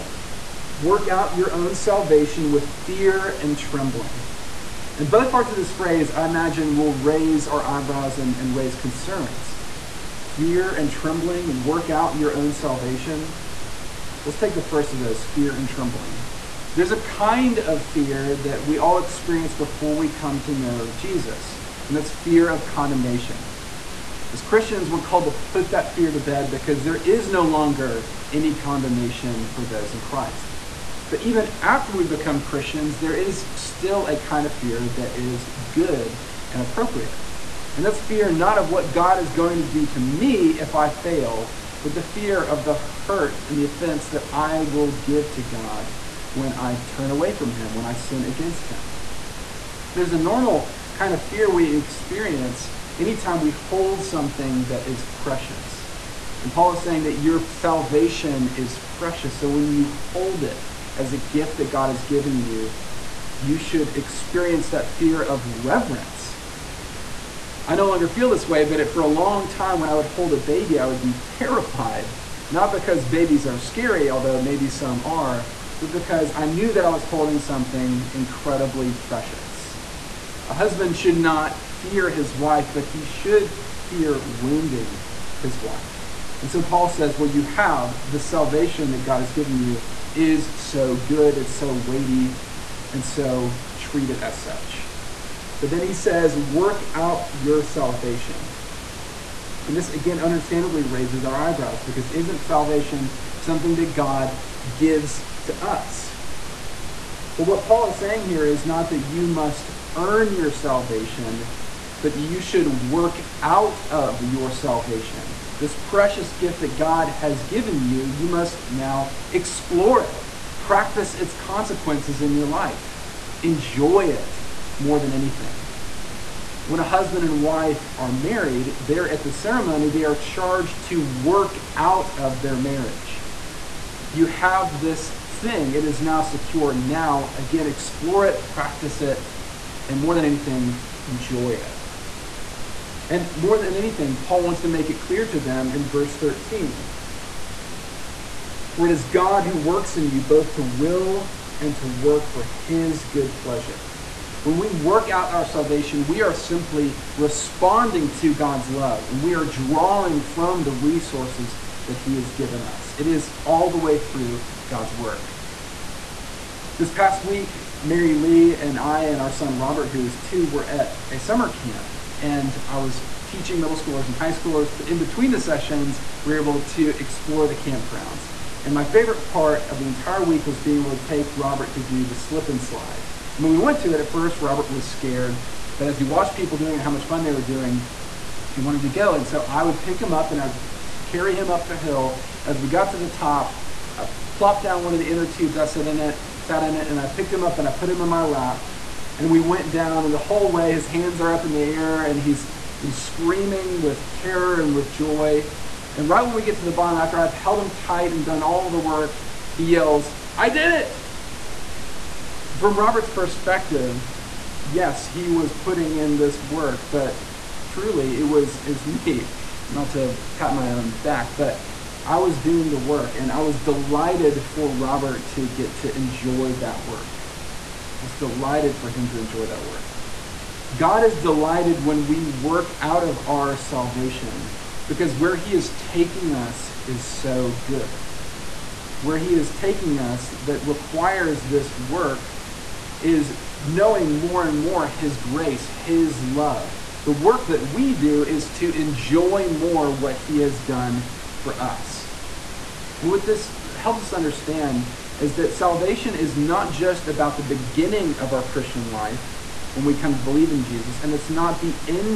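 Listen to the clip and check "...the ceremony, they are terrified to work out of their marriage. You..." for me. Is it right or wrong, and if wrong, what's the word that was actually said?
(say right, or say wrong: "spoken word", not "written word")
wrong: "charged", not "terrified".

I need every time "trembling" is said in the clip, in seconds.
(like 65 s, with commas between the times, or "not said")
3 s, 10 s, 15 s.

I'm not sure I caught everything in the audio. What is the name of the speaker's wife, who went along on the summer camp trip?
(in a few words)
Mary Lee.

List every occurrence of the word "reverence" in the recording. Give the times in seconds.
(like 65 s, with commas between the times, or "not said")
65 s.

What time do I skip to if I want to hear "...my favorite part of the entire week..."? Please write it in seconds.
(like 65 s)
178 s.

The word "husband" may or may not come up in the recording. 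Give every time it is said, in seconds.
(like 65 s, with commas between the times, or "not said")
80 s, 126 s.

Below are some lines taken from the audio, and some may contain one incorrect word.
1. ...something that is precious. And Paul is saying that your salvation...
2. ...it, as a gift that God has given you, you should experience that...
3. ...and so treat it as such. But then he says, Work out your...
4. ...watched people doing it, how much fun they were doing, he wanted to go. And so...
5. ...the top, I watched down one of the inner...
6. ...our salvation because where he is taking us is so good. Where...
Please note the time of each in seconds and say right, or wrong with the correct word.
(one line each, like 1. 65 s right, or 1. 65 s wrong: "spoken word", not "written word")
1. 54 s right
2. 60 s right
3. 92 s right
4. 186 s right
5. 192 s wrong: "plopped", not "watched"
6. 233 s right.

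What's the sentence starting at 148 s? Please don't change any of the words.
For it is God who works in you both to will and to work for his good pleasure.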